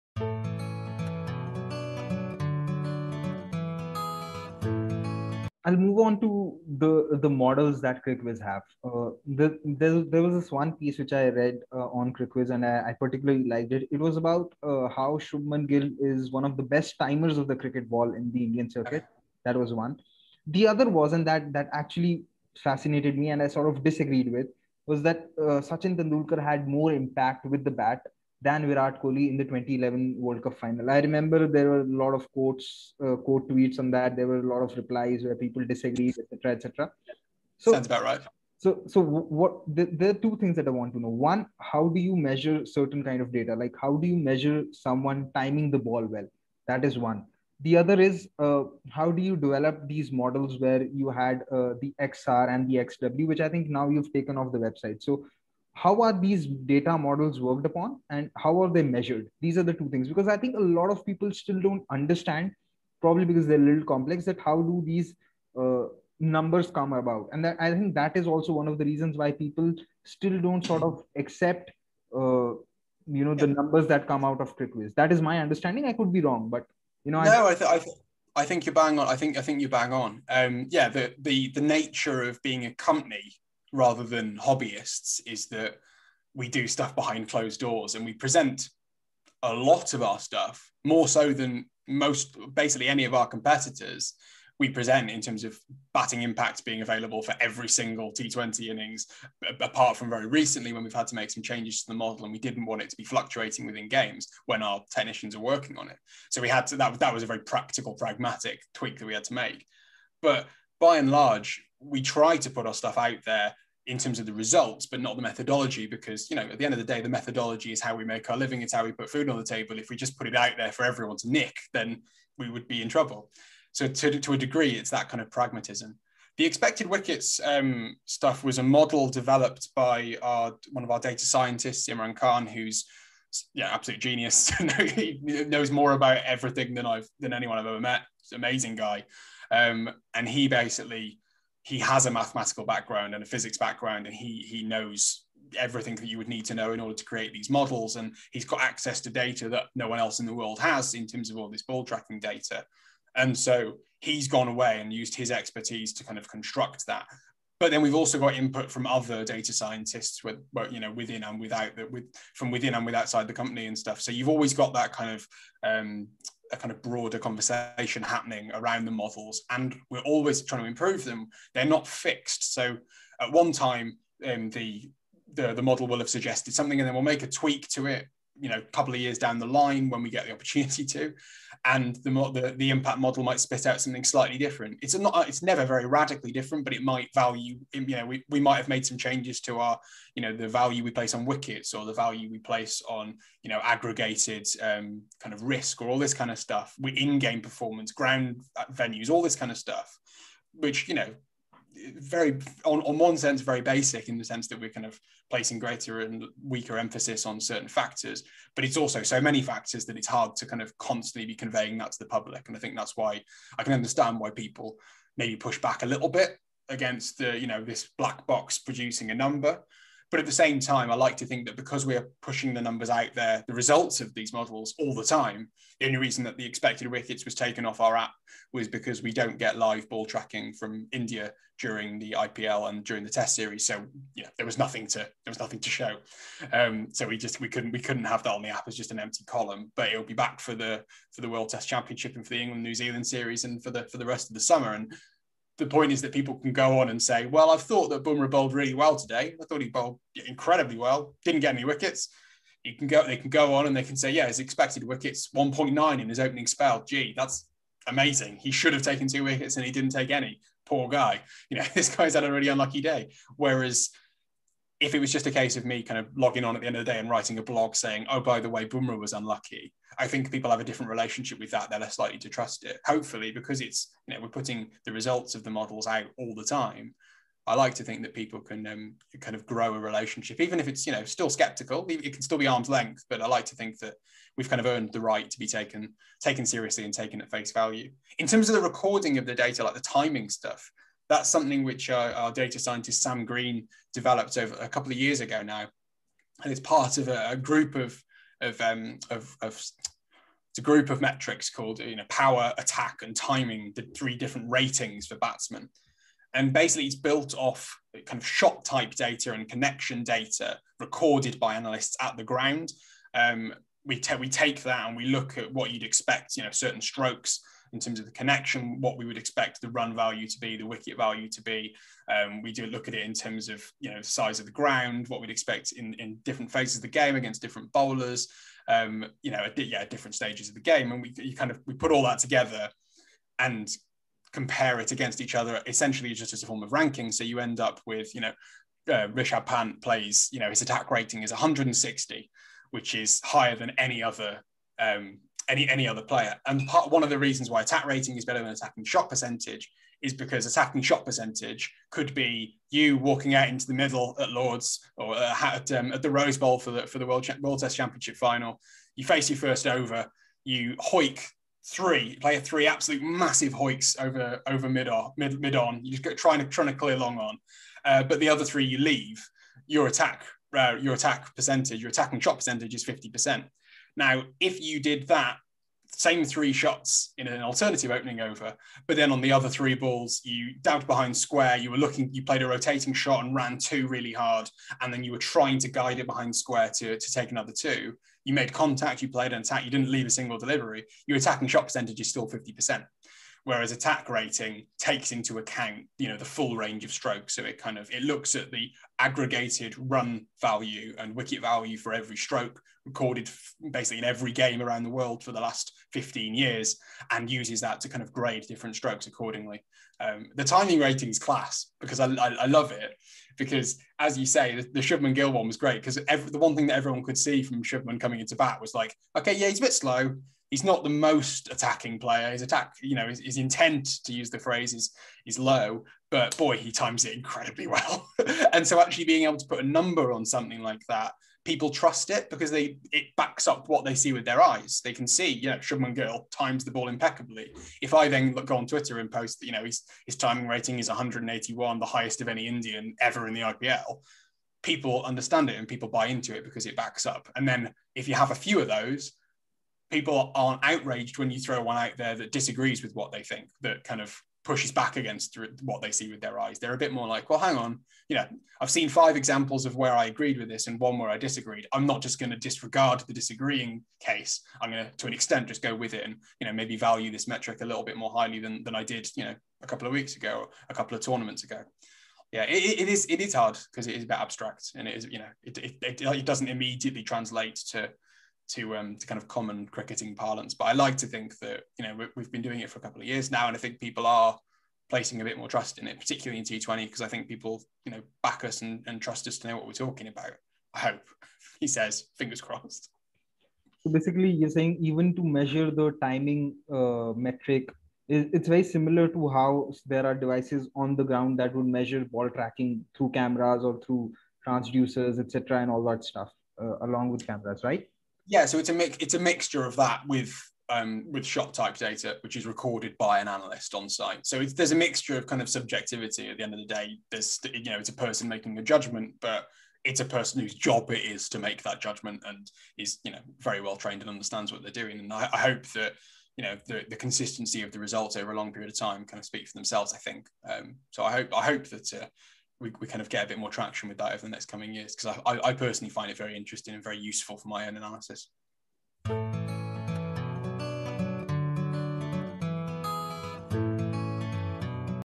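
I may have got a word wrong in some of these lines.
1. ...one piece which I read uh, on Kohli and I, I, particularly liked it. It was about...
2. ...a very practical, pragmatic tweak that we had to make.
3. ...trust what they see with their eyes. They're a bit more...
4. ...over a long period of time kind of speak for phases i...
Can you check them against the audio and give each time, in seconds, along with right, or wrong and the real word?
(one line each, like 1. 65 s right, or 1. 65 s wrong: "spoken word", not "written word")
1. 10 s wrong: "CricViz", not "Kohli"
2. 107 s right
3. 454 s wrong: "against", not "trust"
4. 528 s wrong: "themselves", not "phases".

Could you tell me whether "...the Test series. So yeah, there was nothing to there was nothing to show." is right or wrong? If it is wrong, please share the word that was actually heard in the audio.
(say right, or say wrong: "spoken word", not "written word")
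right.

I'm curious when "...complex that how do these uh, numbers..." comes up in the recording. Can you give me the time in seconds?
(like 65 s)
63 s.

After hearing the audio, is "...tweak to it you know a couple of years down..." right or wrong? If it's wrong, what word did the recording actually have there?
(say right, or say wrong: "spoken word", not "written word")
right.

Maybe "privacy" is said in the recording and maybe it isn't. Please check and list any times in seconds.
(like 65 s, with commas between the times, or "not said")
not said.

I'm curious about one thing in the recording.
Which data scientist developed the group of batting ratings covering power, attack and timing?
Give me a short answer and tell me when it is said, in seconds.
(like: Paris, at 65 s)
Sam Green, at 293 s.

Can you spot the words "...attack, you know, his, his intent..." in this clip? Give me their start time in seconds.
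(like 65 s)
422 s.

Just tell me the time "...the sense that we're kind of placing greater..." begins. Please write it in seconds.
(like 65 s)
204 s.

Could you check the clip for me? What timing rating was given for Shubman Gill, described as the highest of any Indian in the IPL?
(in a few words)
181.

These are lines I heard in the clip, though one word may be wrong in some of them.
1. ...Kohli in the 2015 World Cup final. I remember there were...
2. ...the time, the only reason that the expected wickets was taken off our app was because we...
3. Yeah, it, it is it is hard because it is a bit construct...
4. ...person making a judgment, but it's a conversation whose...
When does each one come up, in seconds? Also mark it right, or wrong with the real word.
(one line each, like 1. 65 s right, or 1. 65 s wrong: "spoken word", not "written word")
1. 29 s wrong: "2011", not "2015"
2. 224 s right
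3. 472 s wrong: "abstract", not "construct"
4. 517 s wrong: "person", not "conversation".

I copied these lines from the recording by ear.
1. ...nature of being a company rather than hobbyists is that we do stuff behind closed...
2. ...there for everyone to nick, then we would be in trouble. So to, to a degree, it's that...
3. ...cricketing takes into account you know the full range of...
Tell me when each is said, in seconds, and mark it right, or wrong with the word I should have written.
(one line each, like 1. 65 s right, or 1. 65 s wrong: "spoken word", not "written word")
1. 81 s right
2. 120 s right
3. 394 s wrong: "rating", not "cricketing".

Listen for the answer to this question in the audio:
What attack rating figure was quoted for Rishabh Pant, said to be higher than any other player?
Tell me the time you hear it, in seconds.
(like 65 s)
341 s.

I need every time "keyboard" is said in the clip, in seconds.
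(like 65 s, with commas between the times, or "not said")
not said.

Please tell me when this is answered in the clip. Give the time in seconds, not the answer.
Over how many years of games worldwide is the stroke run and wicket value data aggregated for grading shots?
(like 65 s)
405 s.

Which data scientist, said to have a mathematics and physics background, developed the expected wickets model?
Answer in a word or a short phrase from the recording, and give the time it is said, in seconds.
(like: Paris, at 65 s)
Imran Khan, at 131 s.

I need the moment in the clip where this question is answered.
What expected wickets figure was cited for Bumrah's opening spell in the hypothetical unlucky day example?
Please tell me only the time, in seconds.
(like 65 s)
255 s.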